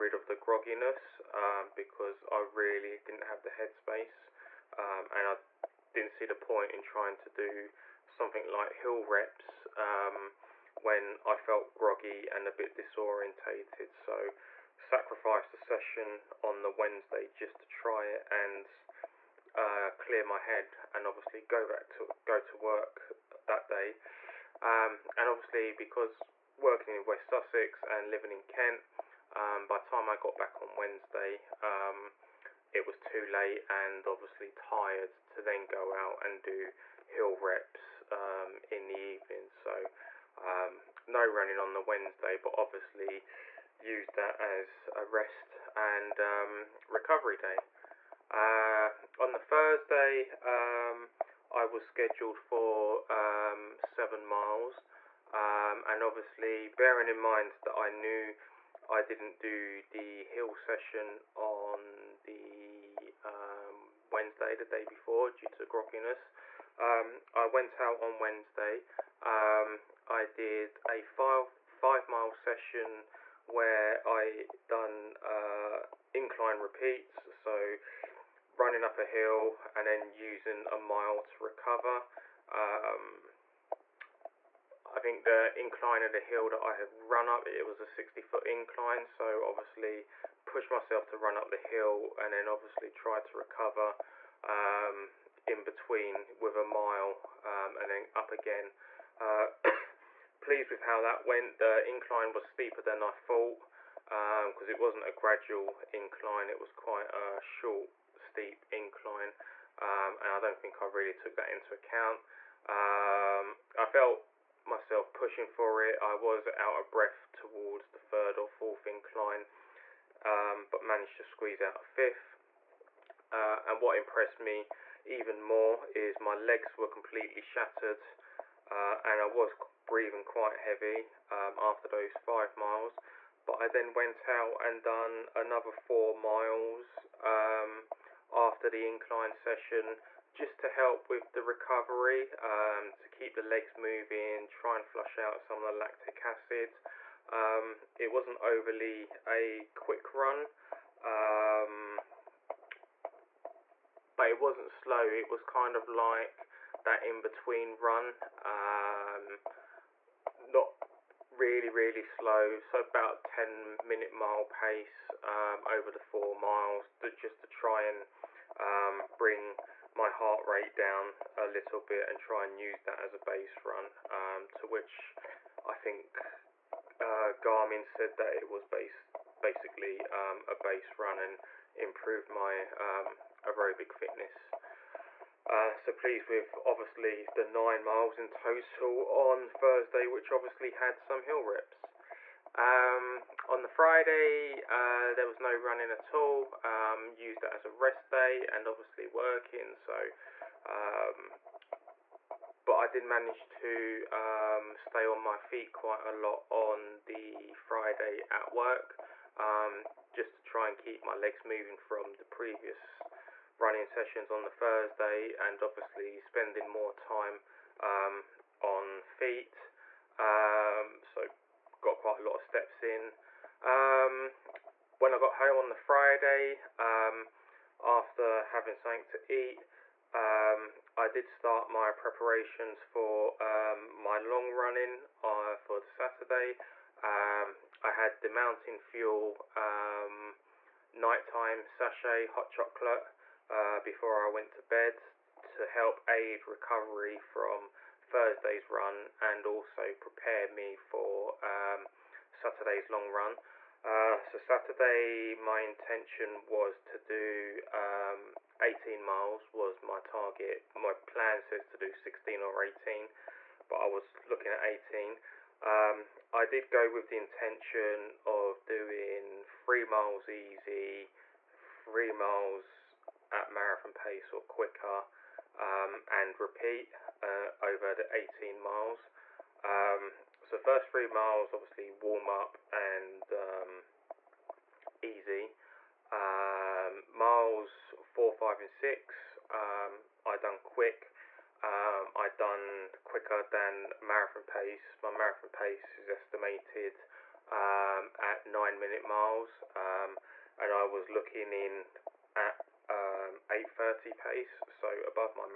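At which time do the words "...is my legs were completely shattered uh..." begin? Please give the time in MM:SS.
02:05.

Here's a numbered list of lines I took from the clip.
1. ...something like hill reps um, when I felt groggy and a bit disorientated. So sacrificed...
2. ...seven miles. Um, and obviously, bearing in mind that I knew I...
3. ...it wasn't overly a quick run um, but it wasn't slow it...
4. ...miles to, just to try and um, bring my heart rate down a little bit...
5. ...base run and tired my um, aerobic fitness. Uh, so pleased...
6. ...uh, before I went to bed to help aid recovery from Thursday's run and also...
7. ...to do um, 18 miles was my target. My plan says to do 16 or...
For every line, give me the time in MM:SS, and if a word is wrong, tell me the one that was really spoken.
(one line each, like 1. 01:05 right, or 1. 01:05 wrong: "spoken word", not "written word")
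1. 00:08 right
2. 00:53 right
3. 02:27 right
4. 02:46 right
5. 03:00 wrong: "improved", not "tired"
6. 04:03 right
7. 04:16 right.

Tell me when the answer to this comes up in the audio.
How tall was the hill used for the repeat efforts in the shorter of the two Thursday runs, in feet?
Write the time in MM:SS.
01:27.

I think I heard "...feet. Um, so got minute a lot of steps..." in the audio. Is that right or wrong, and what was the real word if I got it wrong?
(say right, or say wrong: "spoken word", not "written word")
wrong: "quite", not "minute".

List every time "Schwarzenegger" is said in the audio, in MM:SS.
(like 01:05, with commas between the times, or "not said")
not said.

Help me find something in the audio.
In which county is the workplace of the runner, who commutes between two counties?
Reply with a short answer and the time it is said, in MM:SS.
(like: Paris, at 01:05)
West Sussex, at 00:27.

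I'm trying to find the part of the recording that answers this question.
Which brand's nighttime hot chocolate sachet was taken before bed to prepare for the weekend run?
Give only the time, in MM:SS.
03:58.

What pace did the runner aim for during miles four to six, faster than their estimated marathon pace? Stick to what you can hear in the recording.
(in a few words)
8.30.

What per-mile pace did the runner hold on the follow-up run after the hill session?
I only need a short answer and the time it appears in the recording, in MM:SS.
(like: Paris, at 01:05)
10 minute mile, at 02:43.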